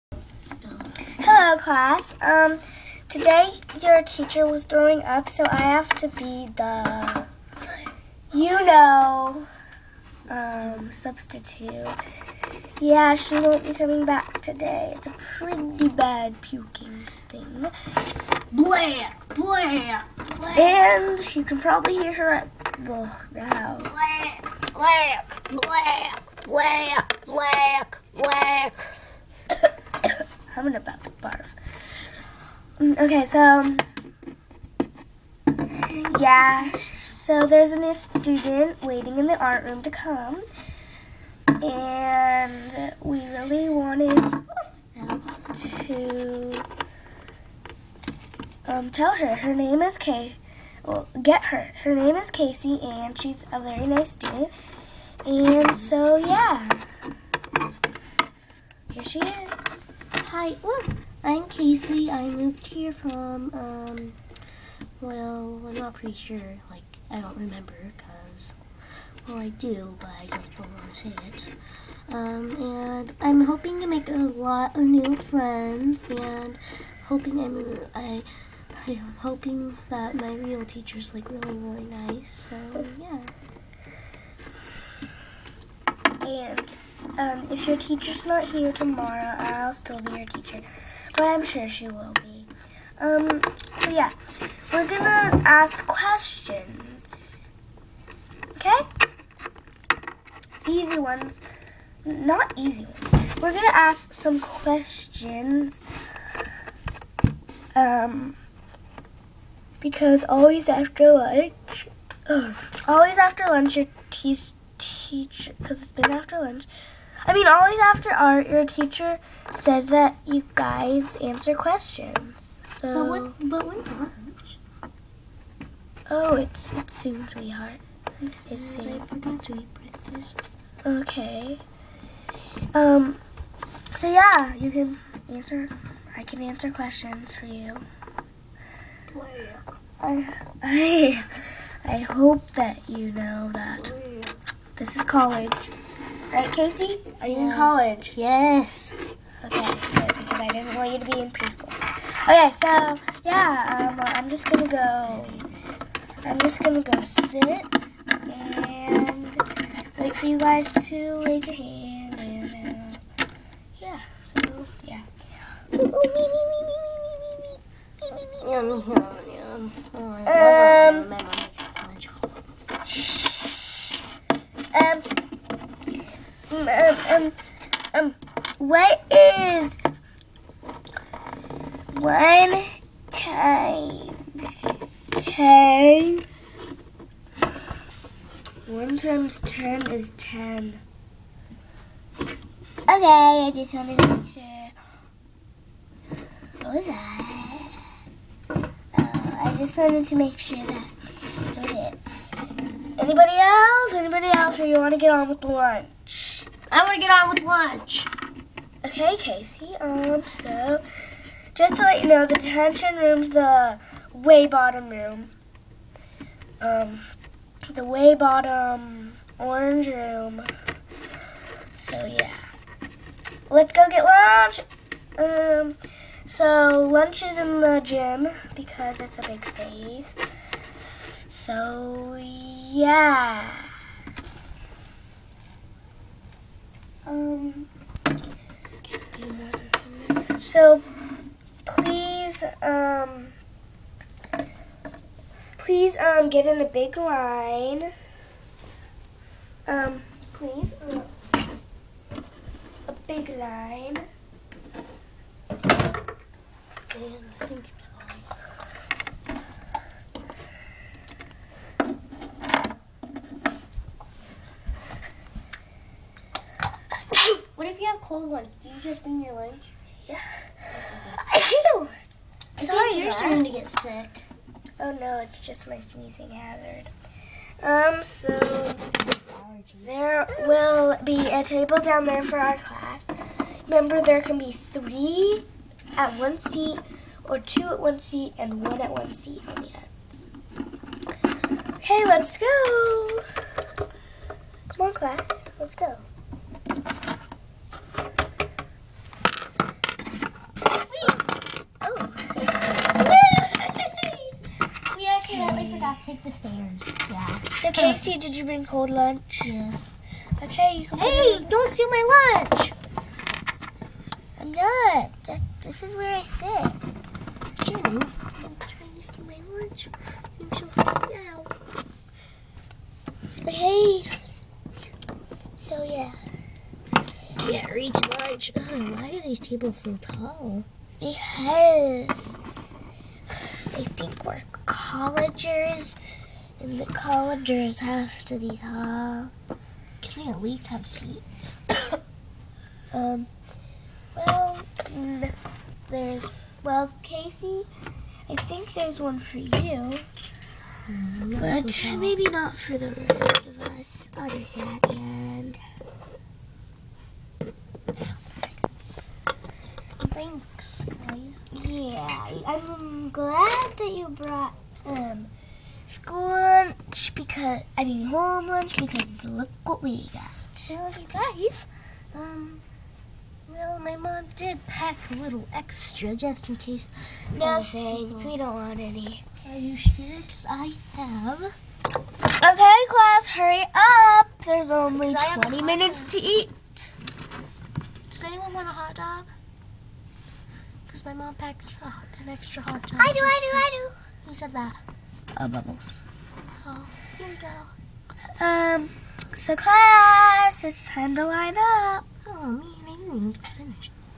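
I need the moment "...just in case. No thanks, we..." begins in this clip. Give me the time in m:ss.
6:16.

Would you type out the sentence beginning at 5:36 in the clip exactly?
And the collegers have to be tall.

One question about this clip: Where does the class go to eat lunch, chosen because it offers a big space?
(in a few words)
the gym.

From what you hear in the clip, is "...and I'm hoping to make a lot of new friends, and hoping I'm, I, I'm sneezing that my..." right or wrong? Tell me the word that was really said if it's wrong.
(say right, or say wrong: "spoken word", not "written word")
wrong: "hoping", not "sneezing".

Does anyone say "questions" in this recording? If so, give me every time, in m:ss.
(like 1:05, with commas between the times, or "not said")
1:35, 1:44, 2:01, 2:16.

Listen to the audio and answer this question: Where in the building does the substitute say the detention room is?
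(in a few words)
the way bottom orange room.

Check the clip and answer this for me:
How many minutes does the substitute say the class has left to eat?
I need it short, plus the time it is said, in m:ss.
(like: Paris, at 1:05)
20, at 6:25.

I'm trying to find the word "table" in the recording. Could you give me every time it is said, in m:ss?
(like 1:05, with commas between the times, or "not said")
4:41, 5:29.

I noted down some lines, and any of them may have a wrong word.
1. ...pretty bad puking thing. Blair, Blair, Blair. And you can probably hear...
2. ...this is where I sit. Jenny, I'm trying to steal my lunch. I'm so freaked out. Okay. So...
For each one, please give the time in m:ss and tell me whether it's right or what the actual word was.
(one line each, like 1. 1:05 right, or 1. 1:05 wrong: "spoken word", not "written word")
1. 0:15 right
2. 5:15 right.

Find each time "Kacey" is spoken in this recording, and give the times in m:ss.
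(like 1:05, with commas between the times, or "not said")
0:52, 1:01, 2:26, 3:29, 5:07, 5:47.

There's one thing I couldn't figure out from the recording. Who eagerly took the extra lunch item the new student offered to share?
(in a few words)
Bubbles.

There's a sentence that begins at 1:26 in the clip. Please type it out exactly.
And um, if your teacher's not here tomorrow, I'll still be your teacher, but I'm sure she will be.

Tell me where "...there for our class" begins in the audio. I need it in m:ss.
4:42.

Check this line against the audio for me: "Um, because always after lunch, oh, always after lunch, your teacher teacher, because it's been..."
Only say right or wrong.
right.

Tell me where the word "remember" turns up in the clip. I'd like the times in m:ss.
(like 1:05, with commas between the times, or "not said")
1:07, 4:43.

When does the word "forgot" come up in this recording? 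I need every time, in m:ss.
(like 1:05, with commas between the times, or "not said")
2:09.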